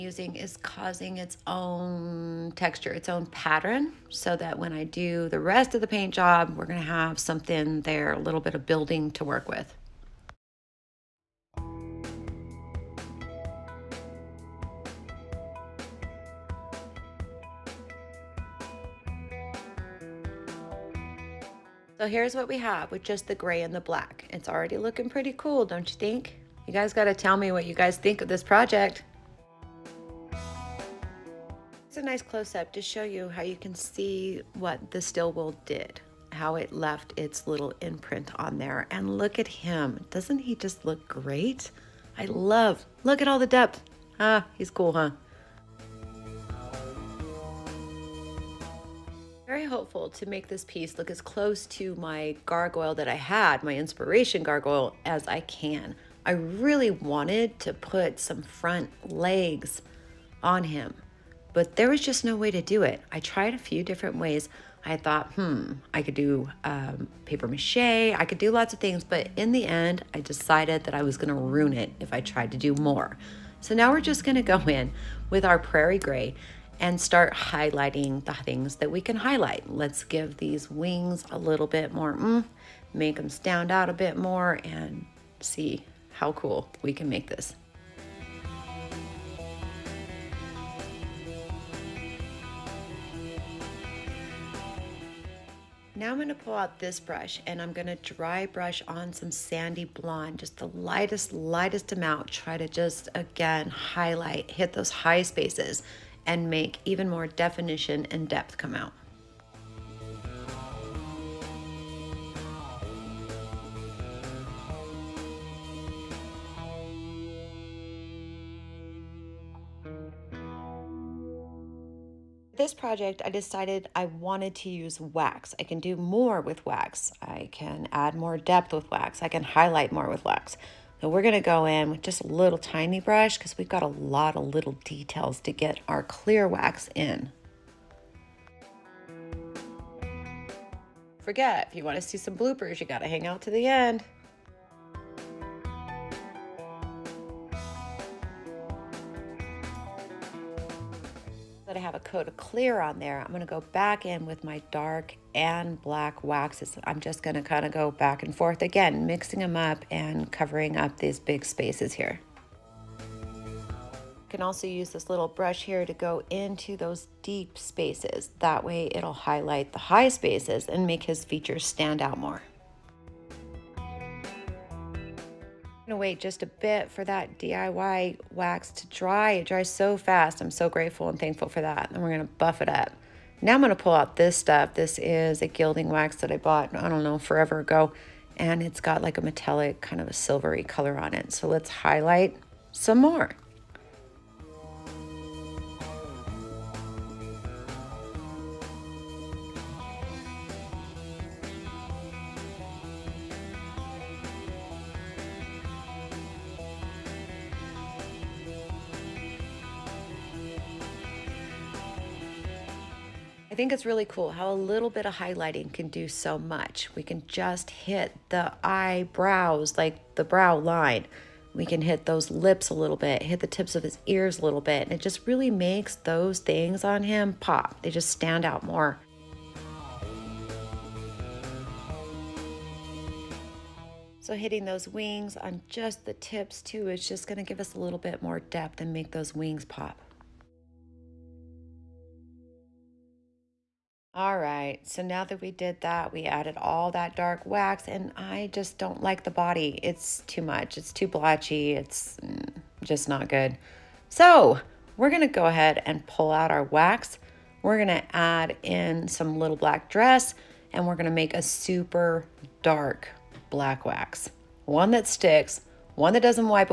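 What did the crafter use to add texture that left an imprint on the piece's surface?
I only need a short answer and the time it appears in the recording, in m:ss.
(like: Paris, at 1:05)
Steel wool, at 0:34.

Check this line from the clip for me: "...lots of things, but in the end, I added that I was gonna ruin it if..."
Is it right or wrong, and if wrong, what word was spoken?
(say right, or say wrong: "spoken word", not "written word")
wrong: "decided", not "added".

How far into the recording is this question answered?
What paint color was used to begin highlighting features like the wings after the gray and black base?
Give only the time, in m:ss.
1:15.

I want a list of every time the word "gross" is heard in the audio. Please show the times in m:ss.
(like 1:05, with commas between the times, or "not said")
not said.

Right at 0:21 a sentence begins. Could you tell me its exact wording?
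So here's what we have with just the gray and the black.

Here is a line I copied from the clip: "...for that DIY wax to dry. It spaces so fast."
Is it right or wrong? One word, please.
wrong.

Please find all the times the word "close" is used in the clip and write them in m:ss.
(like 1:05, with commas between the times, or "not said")
0:32, 0:51.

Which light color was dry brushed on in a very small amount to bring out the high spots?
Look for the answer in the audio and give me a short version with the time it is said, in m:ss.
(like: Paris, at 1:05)
Sandy blonde, at 1:39.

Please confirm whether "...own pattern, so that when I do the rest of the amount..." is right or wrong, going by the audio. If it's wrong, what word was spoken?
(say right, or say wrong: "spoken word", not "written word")
wrong: "paint", not "amount".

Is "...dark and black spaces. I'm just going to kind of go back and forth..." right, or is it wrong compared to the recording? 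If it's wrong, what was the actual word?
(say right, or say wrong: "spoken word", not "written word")
wrong: "waxes", not "spaces".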